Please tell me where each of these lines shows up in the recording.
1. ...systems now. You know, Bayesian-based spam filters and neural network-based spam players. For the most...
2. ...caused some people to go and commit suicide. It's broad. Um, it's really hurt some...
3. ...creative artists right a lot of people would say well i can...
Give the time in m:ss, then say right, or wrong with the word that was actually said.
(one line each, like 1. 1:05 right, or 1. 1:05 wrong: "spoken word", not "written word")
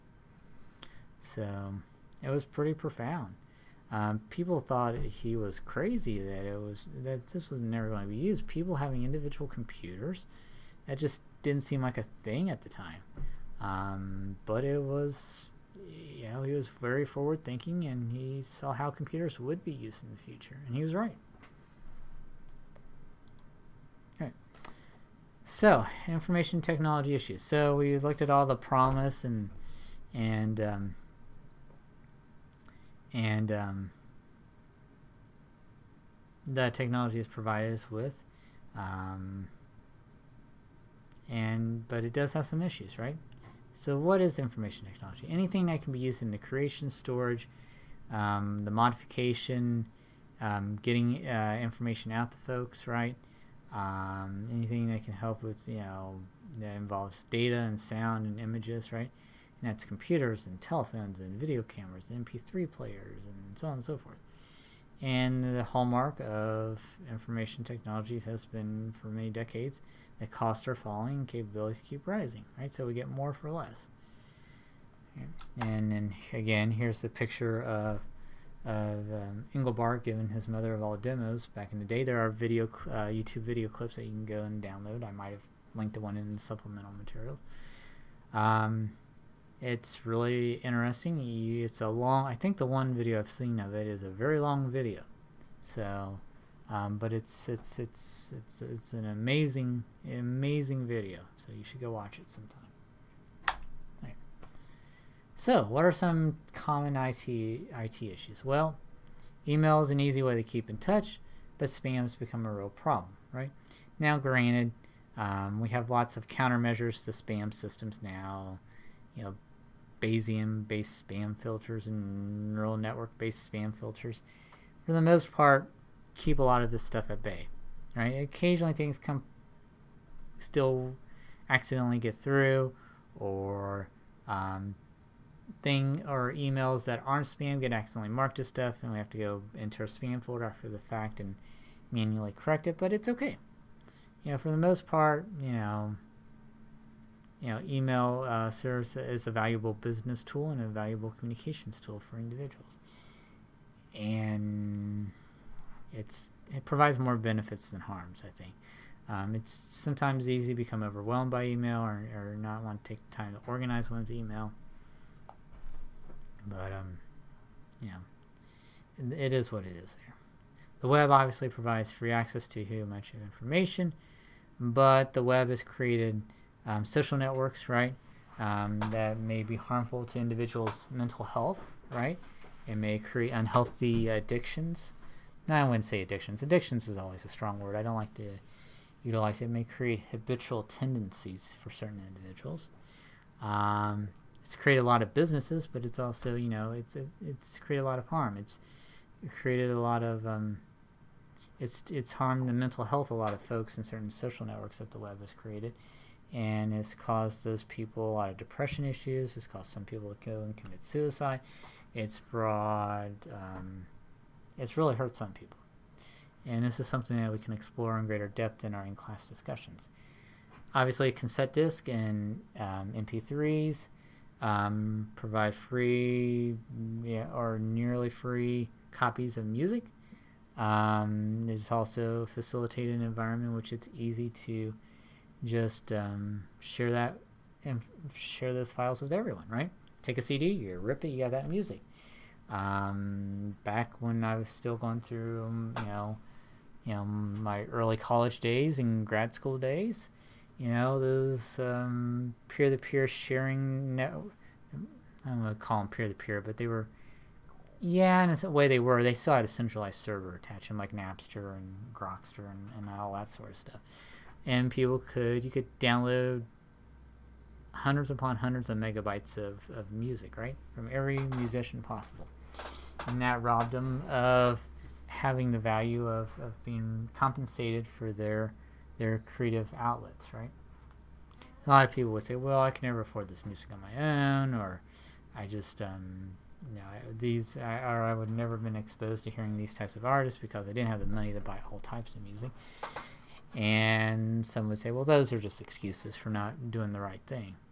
1. 1:57 wrong: "filters", not "players"
2. 3:29 right
3. 4:39 wrong: "outlets", not "artists".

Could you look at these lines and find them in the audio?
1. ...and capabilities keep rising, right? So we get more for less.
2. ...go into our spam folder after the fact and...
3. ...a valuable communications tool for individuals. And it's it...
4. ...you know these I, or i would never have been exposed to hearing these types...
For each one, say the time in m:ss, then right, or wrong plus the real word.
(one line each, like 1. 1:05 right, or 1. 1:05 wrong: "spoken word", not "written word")
1. 1:11 right
2. 2:19 right
3. 2:30 right
4. 4:46 right.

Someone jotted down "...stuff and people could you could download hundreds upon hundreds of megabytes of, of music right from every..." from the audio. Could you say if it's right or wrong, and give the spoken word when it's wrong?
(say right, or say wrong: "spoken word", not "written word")
right.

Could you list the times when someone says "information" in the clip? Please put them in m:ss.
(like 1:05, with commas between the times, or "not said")
0:26, 0:44, 0:51, 1:07, 2:53.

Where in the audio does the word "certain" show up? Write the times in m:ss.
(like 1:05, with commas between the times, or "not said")
3:11, 3:23.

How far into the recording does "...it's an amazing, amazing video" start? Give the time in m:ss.
1:38.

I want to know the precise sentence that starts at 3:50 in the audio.
Um, it's also facilitated an environment in which it's easy to just um, share that and share those files with everyone, right?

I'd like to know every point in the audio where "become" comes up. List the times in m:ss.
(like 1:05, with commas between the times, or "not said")
1:52, 2:40.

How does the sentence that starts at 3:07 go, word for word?
I don't like to utilize it.